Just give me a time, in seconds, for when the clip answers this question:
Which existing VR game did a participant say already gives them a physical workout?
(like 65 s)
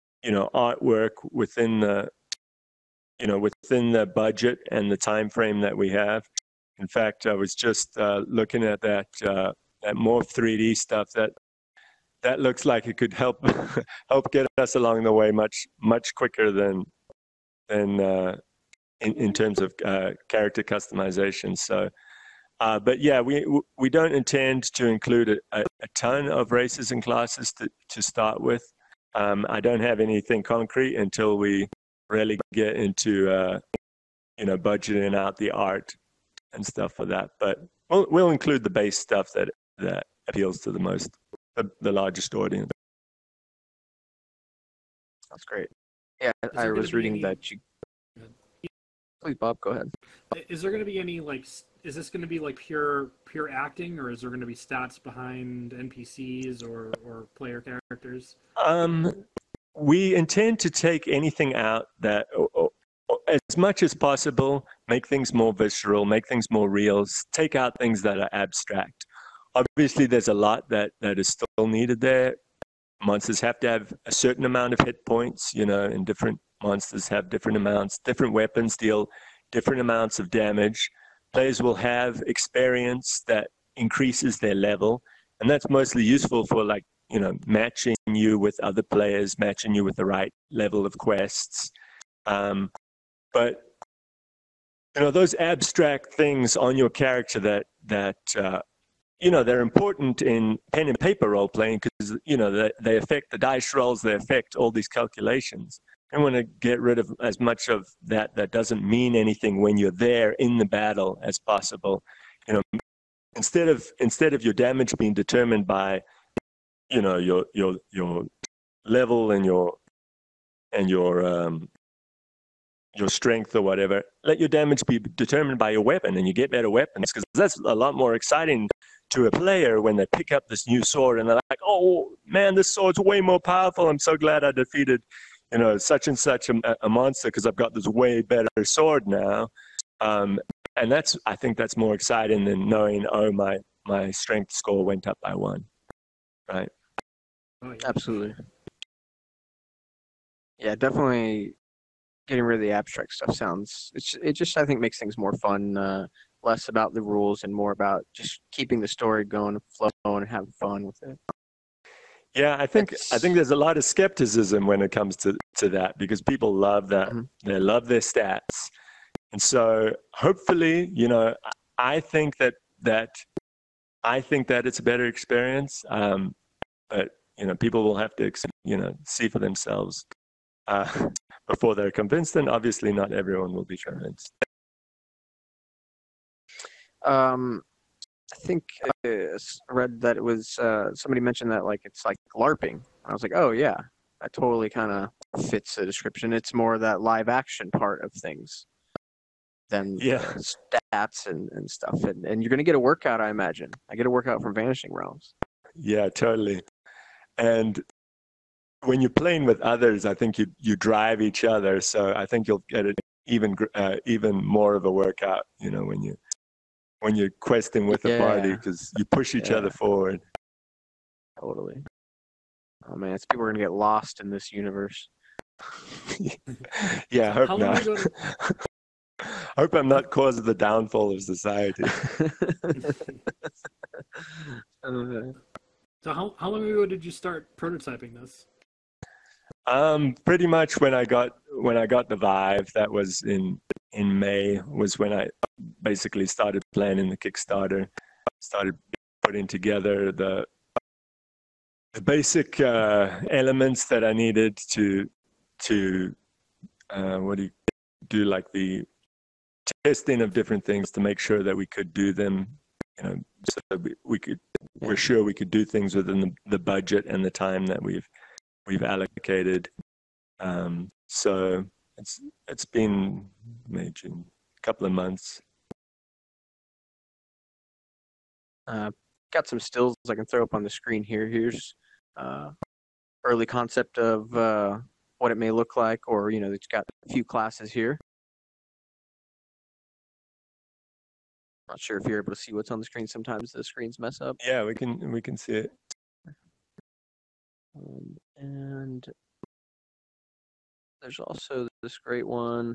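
204 s.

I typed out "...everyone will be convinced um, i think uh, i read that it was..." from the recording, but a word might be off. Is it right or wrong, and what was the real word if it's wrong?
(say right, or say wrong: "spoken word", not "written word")
right.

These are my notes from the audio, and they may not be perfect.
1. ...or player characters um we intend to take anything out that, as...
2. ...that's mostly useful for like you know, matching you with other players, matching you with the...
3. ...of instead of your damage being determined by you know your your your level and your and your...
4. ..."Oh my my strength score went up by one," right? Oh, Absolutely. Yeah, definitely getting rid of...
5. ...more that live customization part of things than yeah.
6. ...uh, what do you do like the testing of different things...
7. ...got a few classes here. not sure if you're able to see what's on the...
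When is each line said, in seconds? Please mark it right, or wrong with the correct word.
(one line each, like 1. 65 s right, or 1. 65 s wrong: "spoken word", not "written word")
1. 57 s right
2. 85 s right
3. 113 s right
4. 143 s right
5. 196 s wrong: "action", not "customization"
6. 256 s right
7. 286 s right.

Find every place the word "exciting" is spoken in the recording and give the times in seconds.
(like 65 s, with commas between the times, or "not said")
128 s, 141 s.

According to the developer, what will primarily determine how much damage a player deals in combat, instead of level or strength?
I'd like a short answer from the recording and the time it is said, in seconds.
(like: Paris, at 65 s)
Weapon, at 125 s.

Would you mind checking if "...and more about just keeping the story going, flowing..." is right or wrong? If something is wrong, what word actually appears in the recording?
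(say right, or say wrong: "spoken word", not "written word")
right.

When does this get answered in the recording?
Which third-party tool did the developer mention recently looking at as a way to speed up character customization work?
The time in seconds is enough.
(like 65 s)
9 s.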